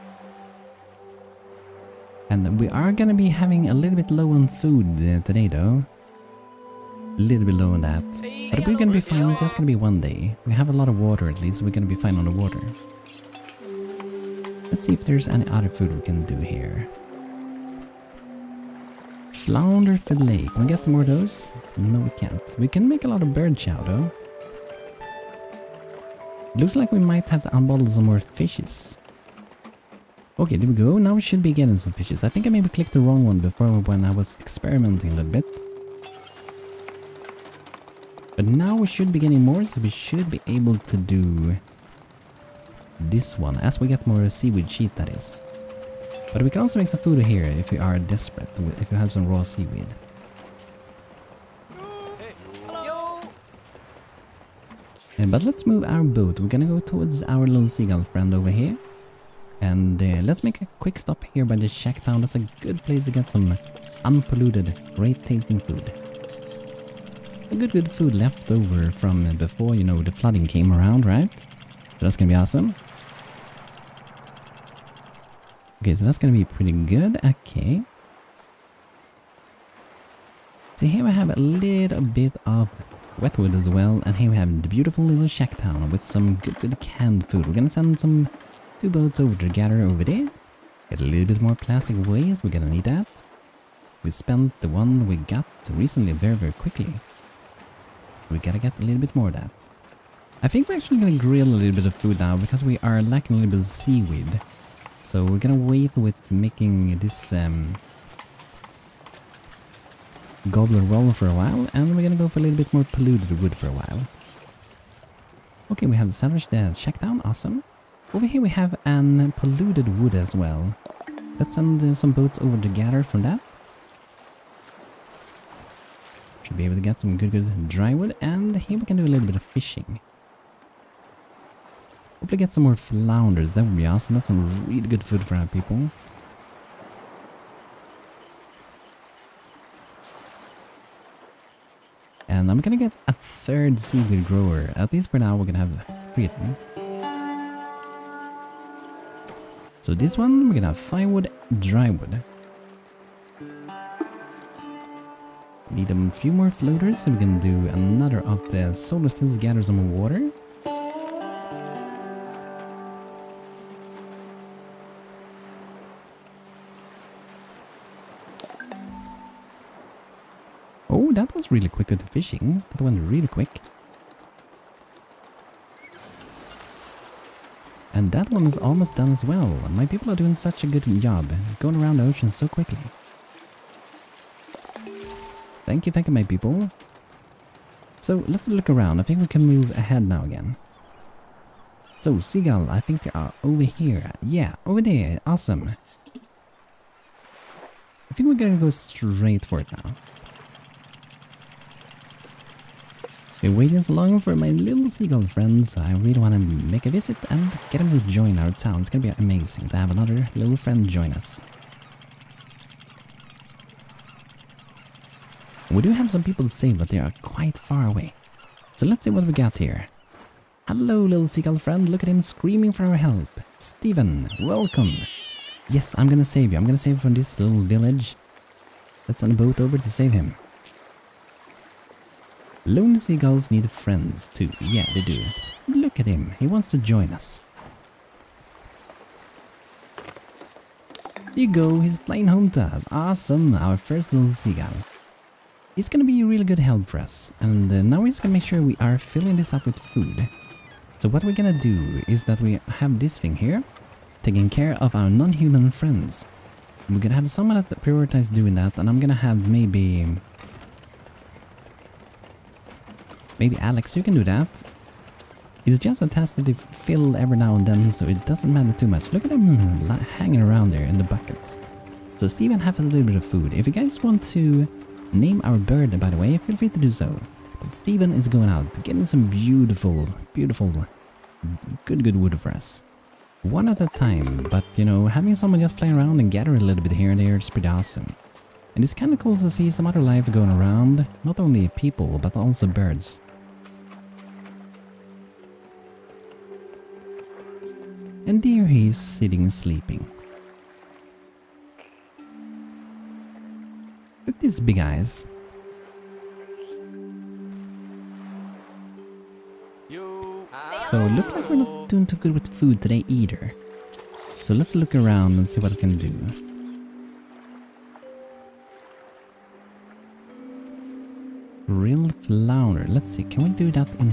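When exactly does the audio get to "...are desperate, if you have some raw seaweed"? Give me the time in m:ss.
0:47.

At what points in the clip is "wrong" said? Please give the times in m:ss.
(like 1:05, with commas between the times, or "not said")
0:33.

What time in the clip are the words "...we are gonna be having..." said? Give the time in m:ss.
0:02.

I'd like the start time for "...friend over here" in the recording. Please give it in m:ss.
0:58.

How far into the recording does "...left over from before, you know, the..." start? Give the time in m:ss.
1:08.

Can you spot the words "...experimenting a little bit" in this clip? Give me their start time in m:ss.
0:34.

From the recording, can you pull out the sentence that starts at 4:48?
And it's kinda cool to see some other life going around, not only people, but also birds.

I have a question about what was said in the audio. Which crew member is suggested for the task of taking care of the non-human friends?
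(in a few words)
Alex.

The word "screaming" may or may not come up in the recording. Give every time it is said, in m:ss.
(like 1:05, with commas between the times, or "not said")
3:42.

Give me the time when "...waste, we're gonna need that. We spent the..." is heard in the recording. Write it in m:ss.
1:32.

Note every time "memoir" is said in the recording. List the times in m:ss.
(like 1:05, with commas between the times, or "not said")
not said.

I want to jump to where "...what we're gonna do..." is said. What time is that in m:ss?
4:11.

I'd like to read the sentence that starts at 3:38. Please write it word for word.
So let's see what we got here.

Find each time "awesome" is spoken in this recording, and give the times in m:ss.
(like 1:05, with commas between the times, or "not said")
1:12, 1:57, 2:13, 3:15, 4:02, 4:47.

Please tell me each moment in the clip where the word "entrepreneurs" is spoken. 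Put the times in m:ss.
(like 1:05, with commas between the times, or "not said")
not said.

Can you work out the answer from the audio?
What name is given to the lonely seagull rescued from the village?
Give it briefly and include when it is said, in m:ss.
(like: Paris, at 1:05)
Stephen, at 3:43.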